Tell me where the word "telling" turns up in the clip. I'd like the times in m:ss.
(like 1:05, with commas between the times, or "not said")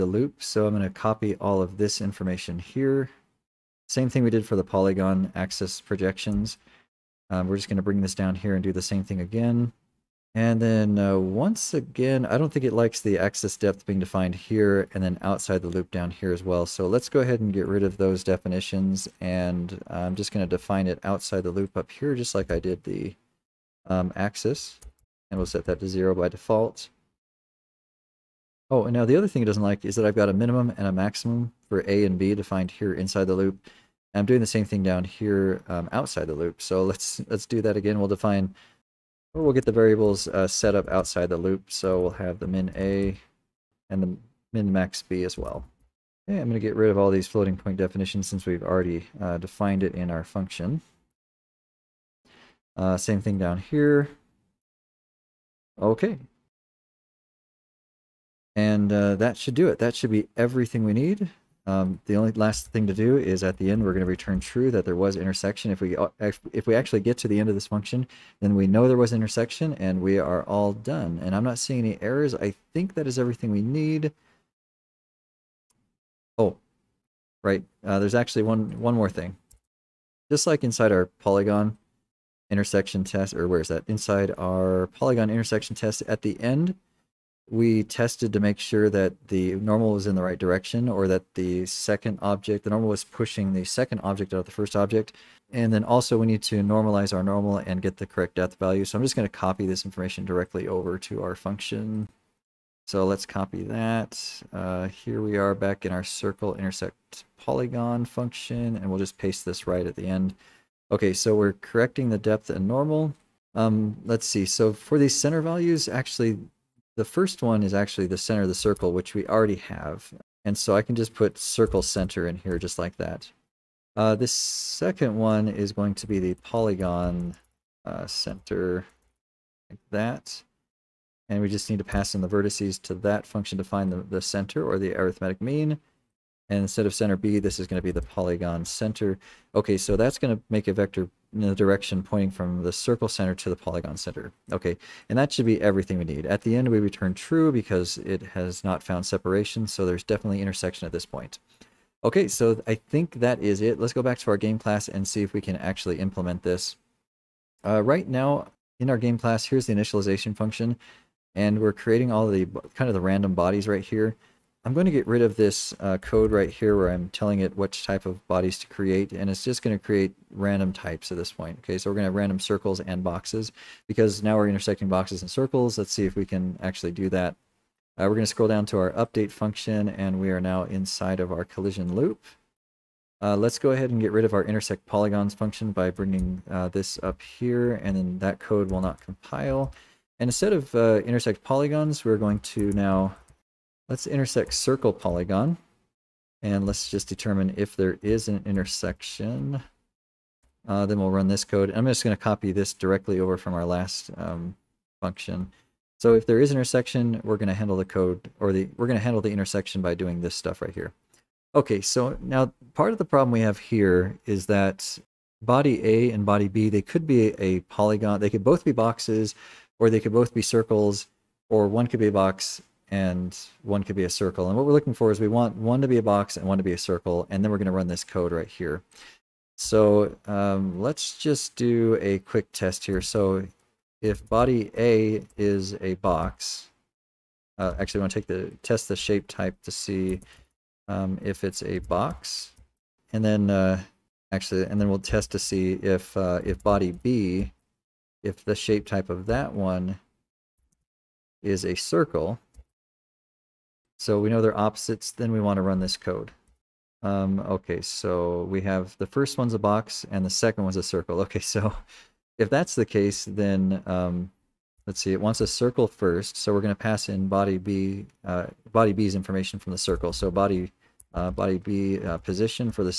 2:47.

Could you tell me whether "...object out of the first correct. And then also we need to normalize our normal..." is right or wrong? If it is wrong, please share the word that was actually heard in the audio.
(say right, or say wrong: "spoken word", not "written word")
wrong: "object", not "correct".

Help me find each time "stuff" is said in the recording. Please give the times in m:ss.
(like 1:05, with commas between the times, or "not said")
3:30.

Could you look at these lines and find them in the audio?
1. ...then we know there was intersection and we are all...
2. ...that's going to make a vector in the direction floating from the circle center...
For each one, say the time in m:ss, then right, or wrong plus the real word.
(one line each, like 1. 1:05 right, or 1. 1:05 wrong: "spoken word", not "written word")
1. 1:08 right
2. 2:19 wrong: "pointing", not "floating".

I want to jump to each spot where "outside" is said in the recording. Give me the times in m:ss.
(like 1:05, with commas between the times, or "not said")
0:15, 0:21, 0:35, 0:40.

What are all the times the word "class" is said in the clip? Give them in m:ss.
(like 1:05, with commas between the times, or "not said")
2:34, 2:39.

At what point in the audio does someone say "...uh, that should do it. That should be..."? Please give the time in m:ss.
0:58.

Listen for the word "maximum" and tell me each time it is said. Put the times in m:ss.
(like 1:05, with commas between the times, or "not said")
0:30.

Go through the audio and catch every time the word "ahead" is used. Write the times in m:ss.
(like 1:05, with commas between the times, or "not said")
0:17, 3:03.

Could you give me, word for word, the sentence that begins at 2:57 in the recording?
Uh, we're going to scroll down to our update function and we are now inside of our collision loop.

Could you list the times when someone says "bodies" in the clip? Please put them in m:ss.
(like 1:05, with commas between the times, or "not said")
2:43, 2:48.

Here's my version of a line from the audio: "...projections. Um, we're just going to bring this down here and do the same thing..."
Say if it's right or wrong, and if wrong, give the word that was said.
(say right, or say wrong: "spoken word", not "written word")
right.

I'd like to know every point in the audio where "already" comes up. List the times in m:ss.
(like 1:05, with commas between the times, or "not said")
0:48, 1:59.